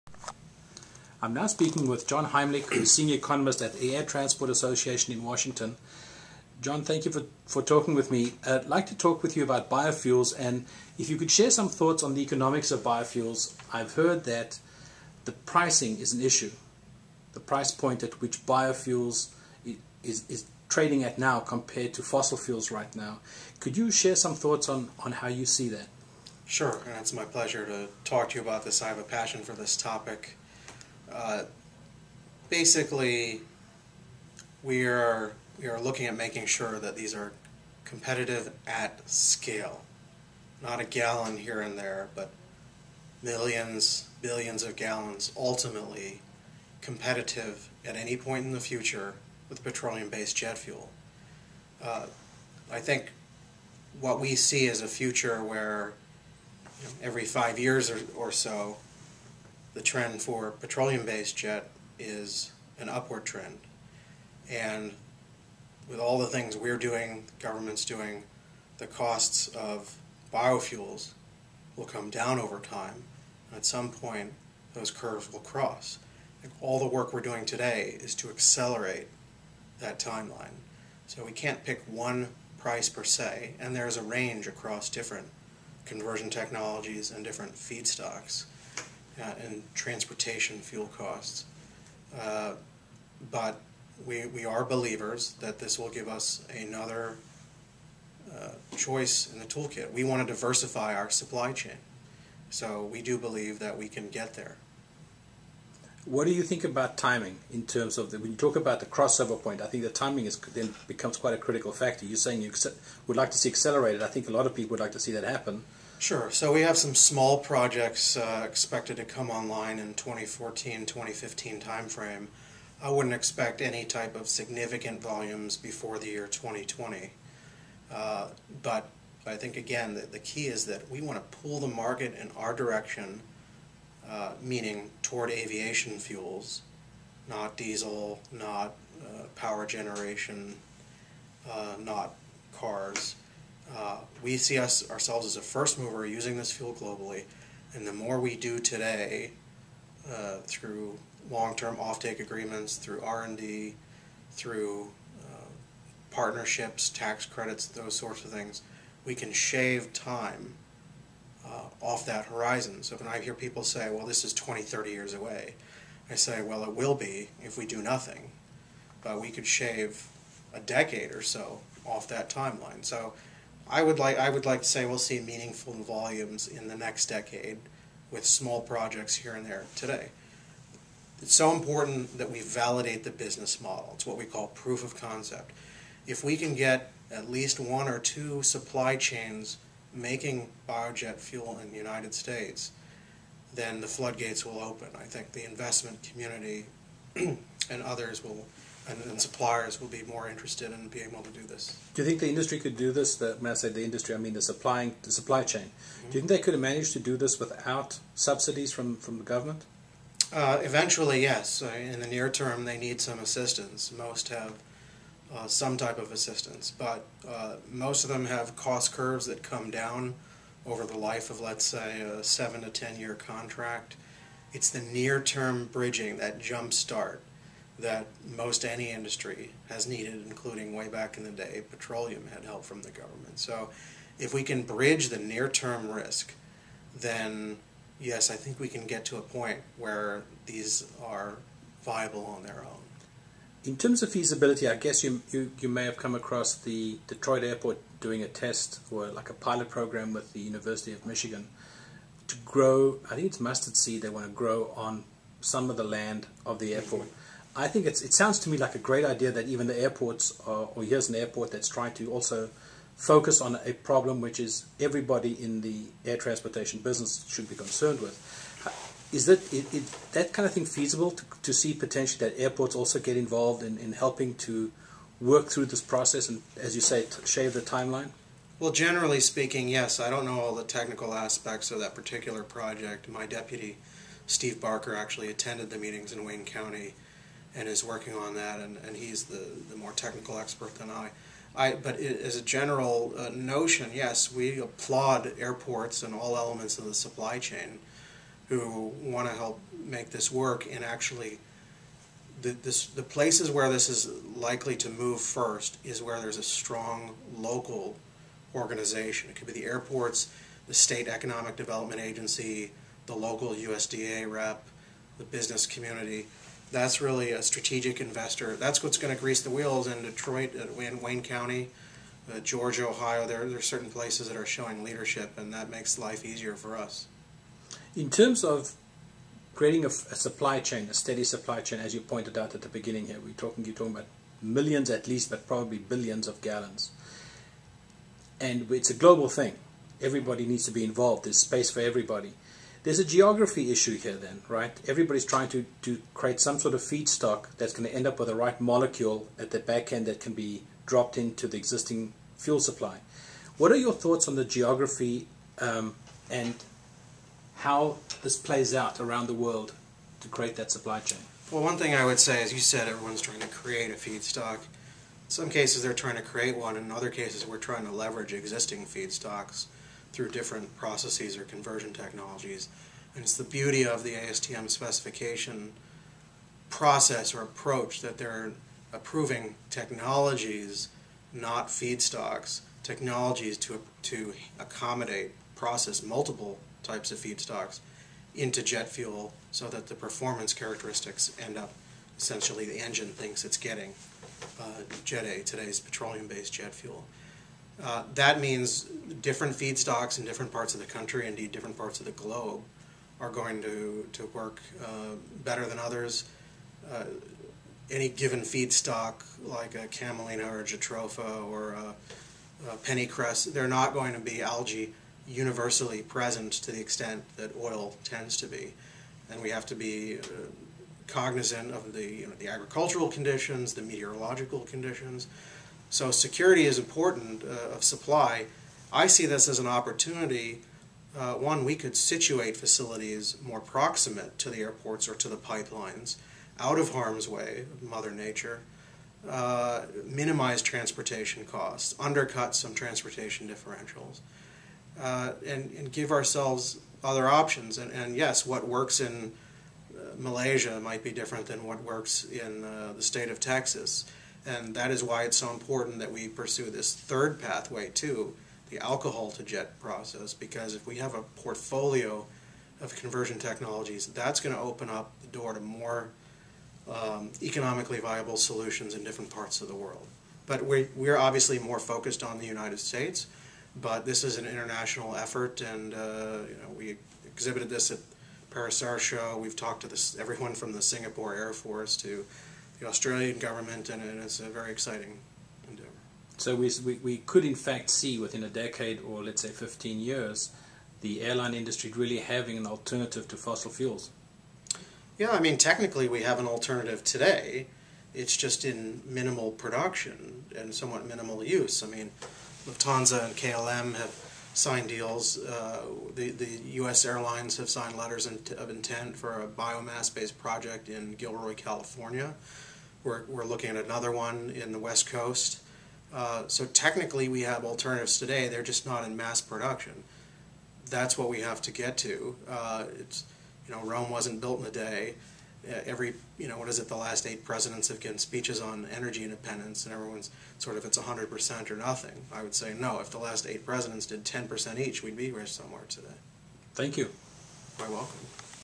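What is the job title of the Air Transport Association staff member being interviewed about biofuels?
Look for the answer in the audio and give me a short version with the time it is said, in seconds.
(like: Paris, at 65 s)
Senior economist, at 2 s.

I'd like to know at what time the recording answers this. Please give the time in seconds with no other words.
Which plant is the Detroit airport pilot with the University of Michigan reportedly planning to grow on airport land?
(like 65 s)
253 s.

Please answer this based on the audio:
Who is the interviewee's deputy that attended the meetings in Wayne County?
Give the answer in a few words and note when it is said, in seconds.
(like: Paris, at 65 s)
Steve Barker, at 284 s.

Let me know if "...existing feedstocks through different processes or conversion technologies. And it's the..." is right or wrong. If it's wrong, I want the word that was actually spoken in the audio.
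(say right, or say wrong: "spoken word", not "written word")
right.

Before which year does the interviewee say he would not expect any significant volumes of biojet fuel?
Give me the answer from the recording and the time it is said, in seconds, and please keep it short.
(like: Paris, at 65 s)
2020, at 126 s.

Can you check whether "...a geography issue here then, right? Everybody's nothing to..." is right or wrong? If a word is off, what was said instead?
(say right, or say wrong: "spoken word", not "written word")
wrong: "trying", not "nothing".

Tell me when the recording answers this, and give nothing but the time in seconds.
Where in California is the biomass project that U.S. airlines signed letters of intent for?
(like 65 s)
511 s.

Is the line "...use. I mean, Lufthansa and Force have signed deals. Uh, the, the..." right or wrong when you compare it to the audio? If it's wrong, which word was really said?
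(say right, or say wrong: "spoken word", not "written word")
wrong: "KLM", not "Force".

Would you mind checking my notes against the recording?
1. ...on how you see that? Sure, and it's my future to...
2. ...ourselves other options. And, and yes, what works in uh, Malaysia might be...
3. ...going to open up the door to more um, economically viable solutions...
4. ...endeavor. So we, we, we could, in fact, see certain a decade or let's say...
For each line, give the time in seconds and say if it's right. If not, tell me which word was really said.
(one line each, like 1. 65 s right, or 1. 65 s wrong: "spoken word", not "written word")
1. 25 s wrong: "pleasure", not "future"
2. 446 s right
3. 464 s right
4. 485 s wrong: "within", not "certain".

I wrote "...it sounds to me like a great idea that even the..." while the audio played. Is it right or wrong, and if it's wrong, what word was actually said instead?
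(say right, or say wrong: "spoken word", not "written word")
right.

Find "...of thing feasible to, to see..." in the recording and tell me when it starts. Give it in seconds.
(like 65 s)
270 s.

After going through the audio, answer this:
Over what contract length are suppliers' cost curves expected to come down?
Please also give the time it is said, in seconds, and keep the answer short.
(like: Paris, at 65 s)
7 to 10 years, at 222 s.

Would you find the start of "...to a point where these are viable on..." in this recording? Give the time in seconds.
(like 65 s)
239 s.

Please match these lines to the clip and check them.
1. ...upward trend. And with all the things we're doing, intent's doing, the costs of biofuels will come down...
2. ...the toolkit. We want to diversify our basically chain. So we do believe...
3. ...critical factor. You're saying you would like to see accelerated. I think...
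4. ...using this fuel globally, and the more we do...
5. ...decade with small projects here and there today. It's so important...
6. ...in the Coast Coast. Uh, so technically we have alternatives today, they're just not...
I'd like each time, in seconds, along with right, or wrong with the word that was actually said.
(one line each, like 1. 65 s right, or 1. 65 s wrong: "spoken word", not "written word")
1. 62 s wrong: "government", not "intent"
2. 99 s wrong: "supply", not "basically"
3. 111 s right
4. 146 s right
5. 177 s right
6. 514 s wrong: "West", not "Coast".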